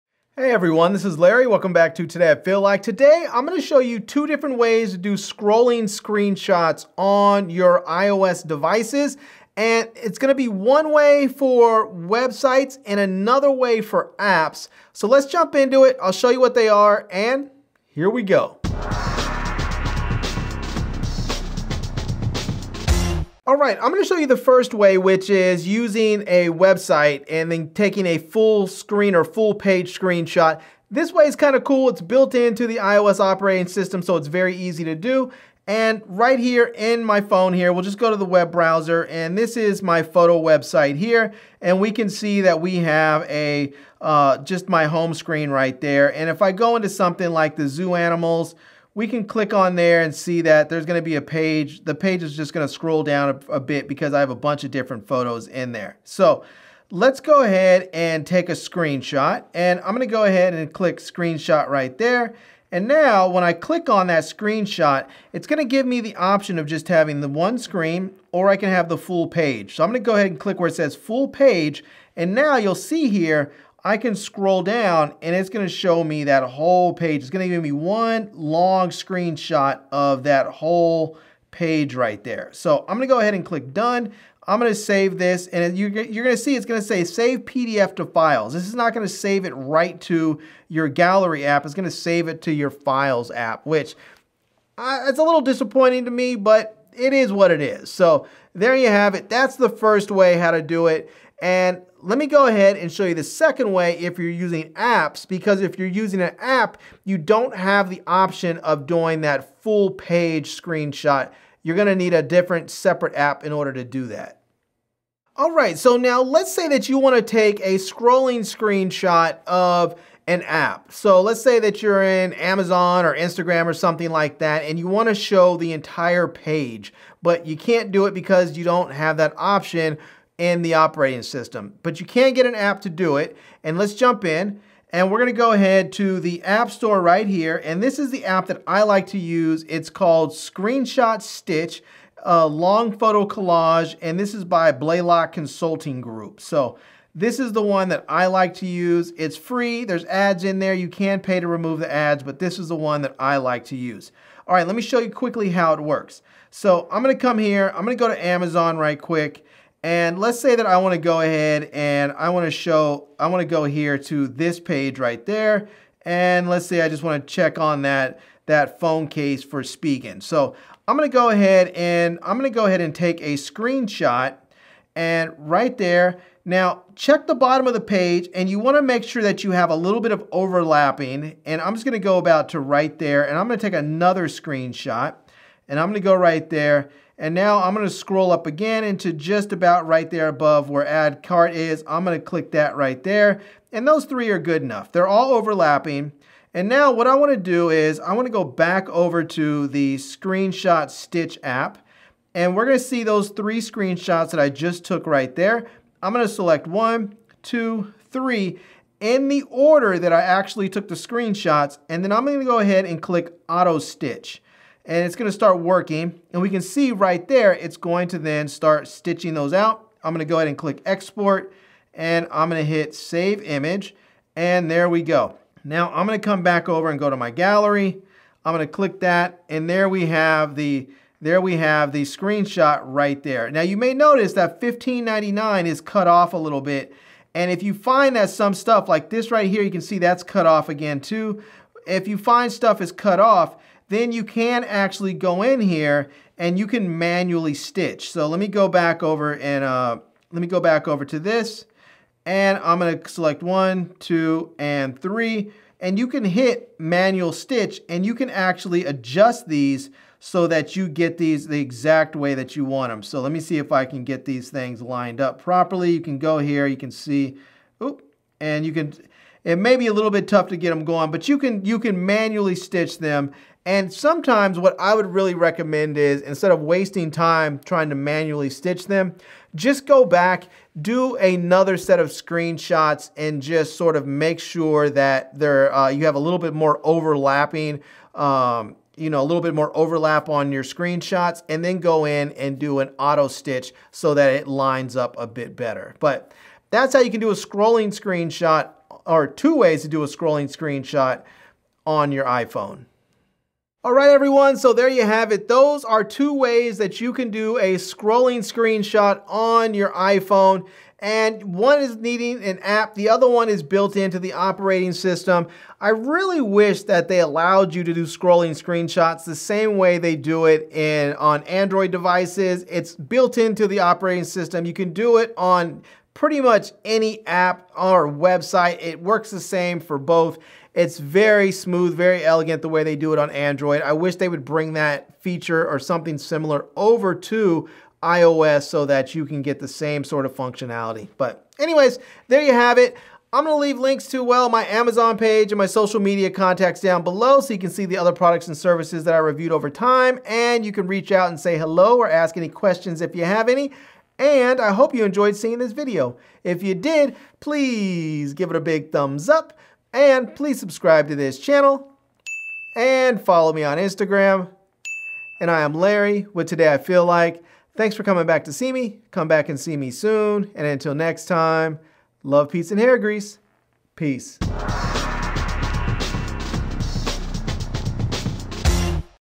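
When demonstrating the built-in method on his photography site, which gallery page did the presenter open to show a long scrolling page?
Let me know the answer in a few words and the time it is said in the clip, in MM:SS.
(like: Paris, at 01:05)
zoo animals, at 00:47.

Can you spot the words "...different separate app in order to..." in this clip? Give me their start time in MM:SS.
01:52.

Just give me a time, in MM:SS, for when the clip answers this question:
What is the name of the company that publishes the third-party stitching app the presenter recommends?
02:24.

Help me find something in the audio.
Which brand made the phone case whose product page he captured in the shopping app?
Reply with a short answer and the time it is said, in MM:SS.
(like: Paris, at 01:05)
Spigen, at 02:49.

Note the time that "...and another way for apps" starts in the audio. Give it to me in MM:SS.
00:12.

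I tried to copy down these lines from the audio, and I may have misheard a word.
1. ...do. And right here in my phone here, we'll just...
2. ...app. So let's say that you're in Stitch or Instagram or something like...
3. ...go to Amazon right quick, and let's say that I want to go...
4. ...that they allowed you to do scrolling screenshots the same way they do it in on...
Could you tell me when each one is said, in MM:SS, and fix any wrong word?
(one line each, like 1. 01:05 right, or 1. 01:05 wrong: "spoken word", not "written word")
1. 00:34 right
2. 02:00 wrong: "Amazon", not "Stitch"
3. 02:37 right
4. 05:16 right.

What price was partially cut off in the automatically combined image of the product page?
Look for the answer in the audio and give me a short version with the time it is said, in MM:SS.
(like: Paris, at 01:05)
15.99, at 03:54.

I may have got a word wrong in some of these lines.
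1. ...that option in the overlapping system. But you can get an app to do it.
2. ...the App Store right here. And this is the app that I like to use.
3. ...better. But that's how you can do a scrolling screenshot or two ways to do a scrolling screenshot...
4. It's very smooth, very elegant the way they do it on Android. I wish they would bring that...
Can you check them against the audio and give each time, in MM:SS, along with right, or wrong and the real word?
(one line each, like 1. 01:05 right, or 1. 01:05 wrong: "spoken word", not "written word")
1. 02:09 wrong: "operating", not "overlapping"
2. 02:16 right
3. 04:55 right
4. 05:30 right.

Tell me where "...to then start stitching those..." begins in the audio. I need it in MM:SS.
03:38.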